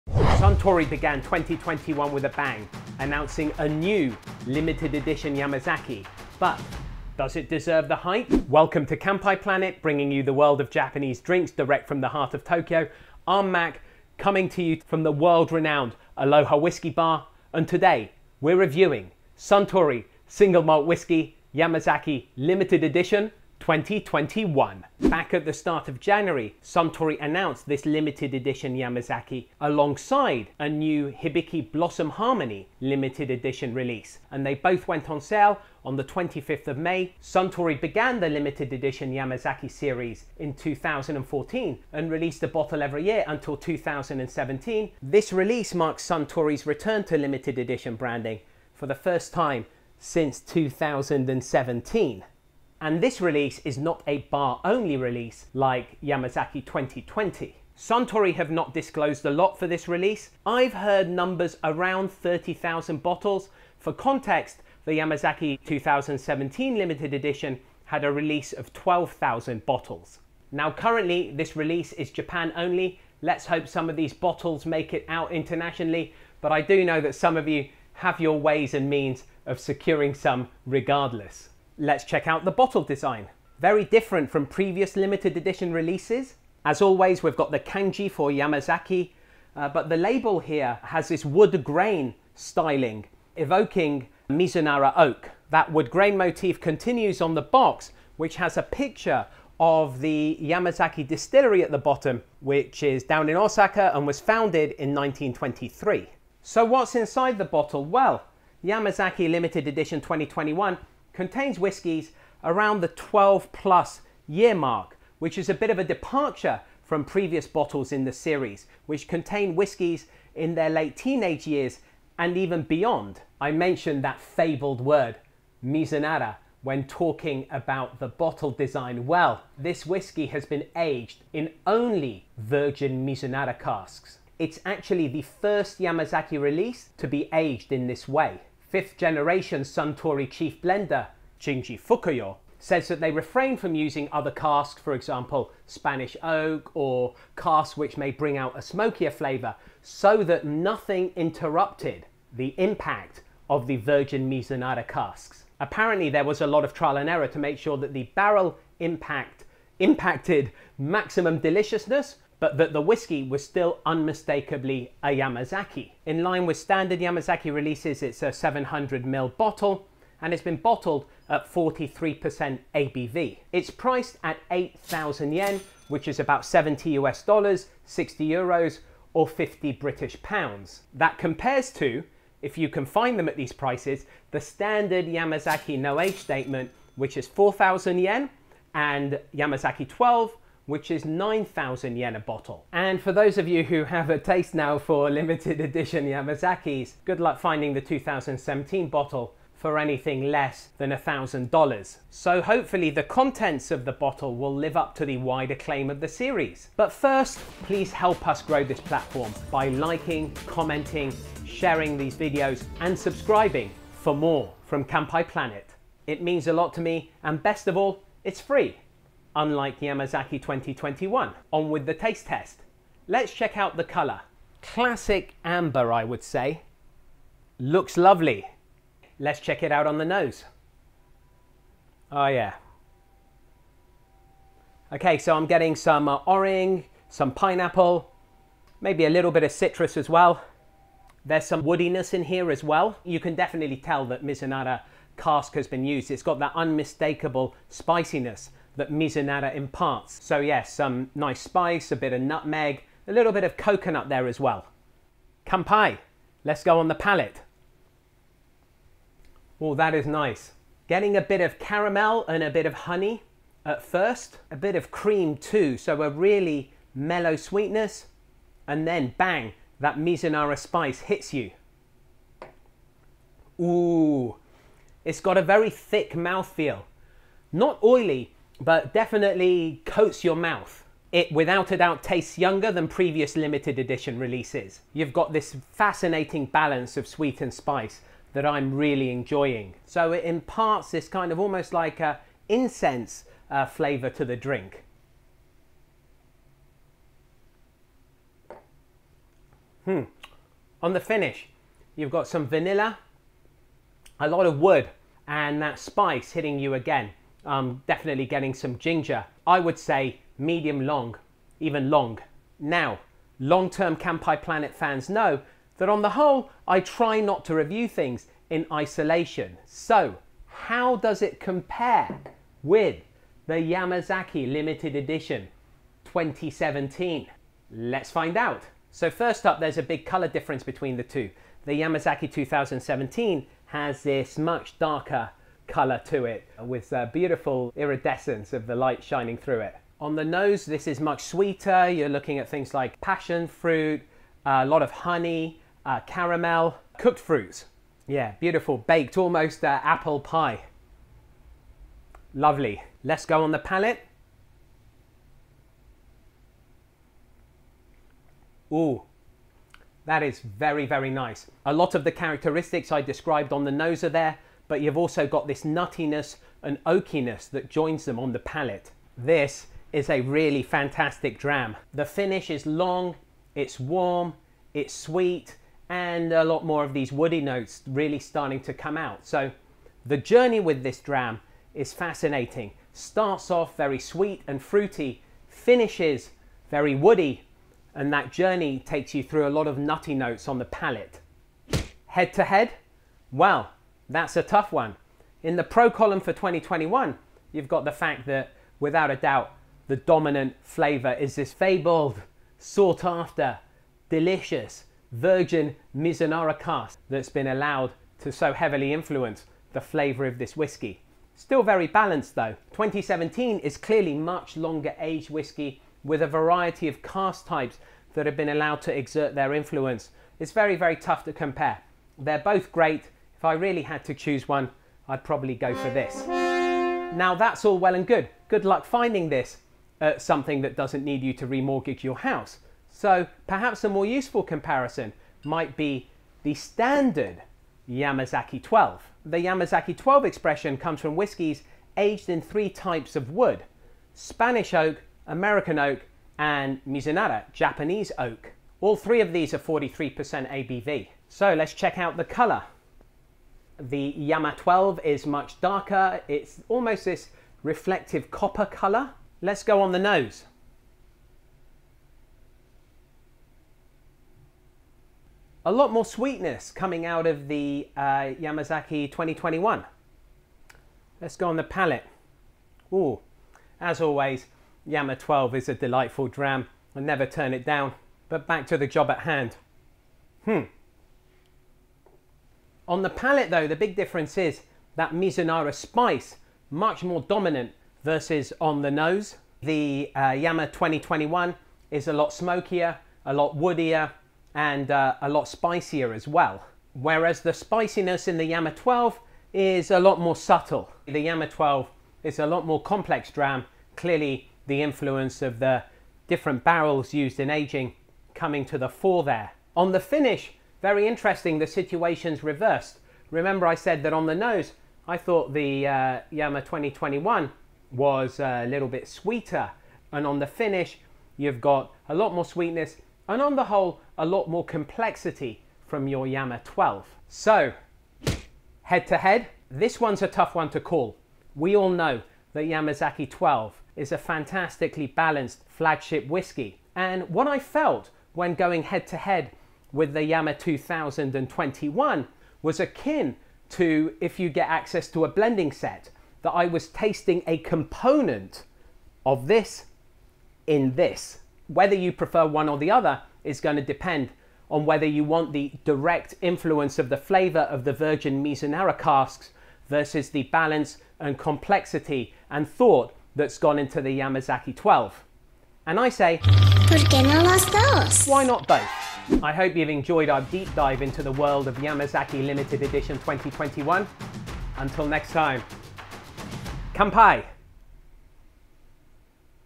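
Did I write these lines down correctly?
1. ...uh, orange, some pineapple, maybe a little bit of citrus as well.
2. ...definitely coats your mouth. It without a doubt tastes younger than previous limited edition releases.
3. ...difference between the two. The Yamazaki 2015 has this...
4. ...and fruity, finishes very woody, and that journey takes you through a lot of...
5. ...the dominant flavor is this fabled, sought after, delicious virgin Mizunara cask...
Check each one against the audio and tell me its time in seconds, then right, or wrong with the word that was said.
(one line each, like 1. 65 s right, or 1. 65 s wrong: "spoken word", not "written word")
1. 236 s right
2. 278 s right
3. 330 s wrong: "2017", not "2015"
4. 384 s right
5. 399 s right.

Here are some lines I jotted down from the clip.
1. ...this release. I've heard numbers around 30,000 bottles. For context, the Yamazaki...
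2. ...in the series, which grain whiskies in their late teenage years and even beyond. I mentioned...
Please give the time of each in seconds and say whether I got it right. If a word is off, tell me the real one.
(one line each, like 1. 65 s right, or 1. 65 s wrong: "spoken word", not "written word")
1. 59 s right
2. 117 s wrong: "contain", not "grain".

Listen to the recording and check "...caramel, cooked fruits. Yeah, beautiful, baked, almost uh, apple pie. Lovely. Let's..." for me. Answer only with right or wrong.
right.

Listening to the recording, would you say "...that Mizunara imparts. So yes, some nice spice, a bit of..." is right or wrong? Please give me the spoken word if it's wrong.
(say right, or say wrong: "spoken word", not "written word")
right.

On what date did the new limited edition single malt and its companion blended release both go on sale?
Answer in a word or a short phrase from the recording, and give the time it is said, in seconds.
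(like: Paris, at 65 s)
25th of May, at 36 s.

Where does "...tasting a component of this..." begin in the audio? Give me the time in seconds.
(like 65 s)
546 s.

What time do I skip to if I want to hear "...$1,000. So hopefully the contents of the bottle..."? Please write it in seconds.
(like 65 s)
200 s.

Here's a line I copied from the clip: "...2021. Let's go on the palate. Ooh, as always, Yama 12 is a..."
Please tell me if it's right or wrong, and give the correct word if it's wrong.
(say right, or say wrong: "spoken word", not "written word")
right.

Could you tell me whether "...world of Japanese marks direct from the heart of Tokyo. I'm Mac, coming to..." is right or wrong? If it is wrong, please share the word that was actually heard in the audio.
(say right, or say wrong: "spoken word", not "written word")
wrong: "drinks", not "marks".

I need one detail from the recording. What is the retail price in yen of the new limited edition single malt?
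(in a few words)
8,000 yen.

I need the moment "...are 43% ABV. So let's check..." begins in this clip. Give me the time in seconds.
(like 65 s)
449 s.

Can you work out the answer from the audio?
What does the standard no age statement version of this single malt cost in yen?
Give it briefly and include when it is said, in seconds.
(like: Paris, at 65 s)
4,000 yen, at 187 s.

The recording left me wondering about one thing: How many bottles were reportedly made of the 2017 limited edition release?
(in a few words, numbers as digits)
12,000.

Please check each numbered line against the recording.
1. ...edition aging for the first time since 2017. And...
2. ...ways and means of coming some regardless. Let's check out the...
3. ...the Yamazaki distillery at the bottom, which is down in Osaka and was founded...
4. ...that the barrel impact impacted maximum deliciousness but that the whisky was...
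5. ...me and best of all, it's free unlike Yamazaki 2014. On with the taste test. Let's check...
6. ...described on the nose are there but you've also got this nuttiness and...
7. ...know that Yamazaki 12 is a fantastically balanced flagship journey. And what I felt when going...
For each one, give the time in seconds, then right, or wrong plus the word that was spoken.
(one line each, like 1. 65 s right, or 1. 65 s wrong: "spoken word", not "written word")
1. 47 s wrong: "branding", not "aging"
2. 78 s wrong: "securing", not "coming"
3. 100 s right
4. 157 s right
5. 216 s wrong: "2021", not "2014"
6. 363 s right
7. 531 s wrong: "whiskey", not "journey".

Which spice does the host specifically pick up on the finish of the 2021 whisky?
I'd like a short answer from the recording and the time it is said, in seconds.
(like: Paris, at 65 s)
ginger, at 308 s.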